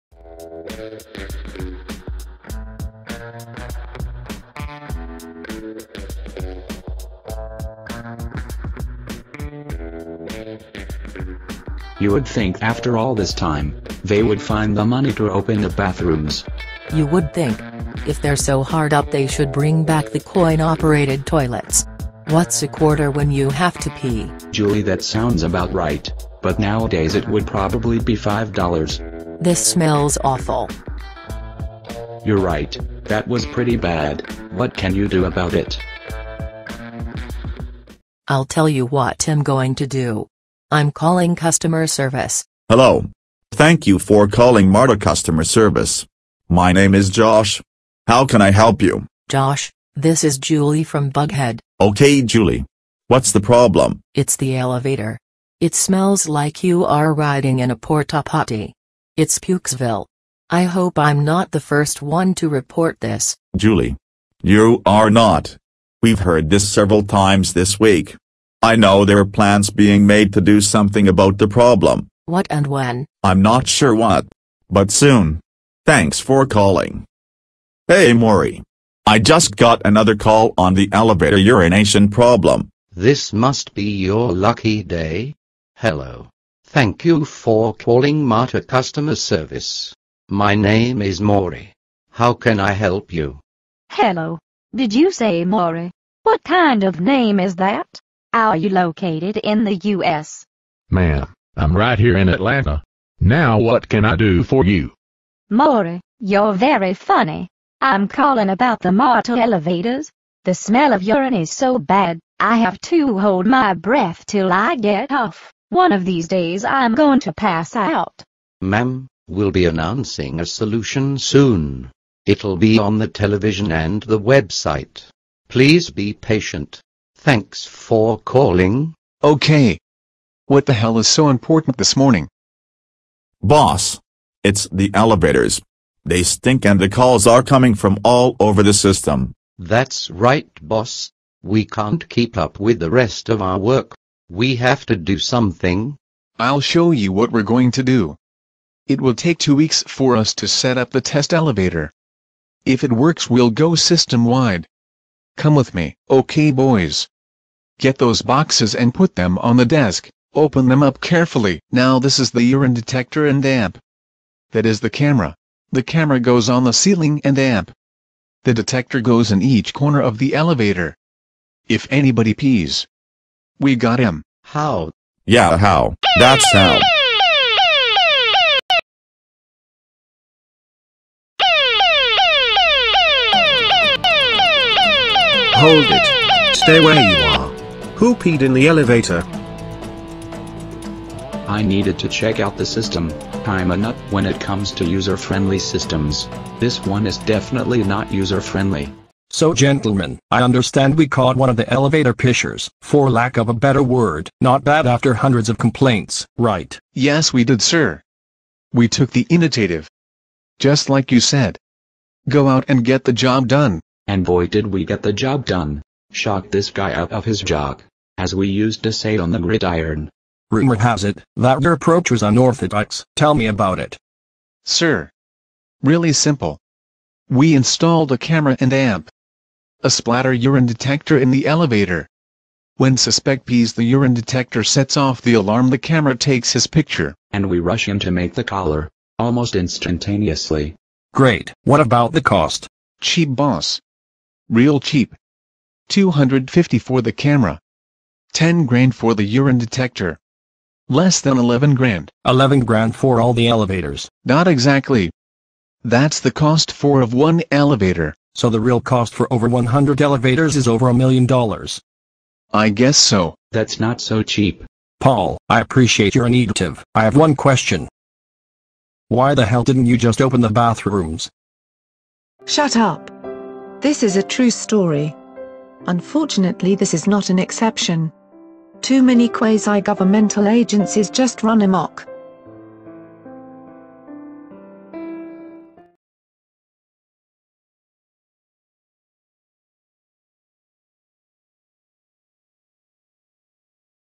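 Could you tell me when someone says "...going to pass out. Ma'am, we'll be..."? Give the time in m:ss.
1:56.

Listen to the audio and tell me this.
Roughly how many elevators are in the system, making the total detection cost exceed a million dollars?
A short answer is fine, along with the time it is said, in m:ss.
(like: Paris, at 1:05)
over 100, at 4:19.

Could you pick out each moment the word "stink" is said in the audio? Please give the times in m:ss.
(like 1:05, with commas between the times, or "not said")
2:16.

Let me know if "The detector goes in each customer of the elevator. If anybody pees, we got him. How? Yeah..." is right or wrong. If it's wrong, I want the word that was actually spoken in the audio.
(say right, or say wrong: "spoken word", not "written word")
wrong: "corner", not "customer".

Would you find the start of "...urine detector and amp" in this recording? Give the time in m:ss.
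2:42.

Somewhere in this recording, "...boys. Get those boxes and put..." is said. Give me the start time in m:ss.
2:36.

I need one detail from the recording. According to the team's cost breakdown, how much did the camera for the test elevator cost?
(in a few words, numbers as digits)
250.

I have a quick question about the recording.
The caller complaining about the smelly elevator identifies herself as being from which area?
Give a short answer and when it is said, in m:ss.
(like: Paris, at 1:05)
Buckhead, at 0:51.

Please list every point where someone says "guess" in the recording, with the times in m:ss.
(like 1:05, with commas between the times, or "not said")
4:22.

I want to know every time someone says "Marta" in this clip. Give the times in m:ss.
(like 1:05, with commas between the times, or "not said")
0:44, 1:28, 1:48.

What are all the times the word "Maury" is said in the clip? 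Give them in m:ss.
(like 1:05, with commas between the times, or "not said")
1:18, 1:31, 1:35, 1:45.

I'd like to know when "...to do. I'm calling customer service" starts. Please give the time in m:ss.
0:39.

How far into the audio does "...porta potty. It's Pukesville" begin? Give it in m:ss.
0:57.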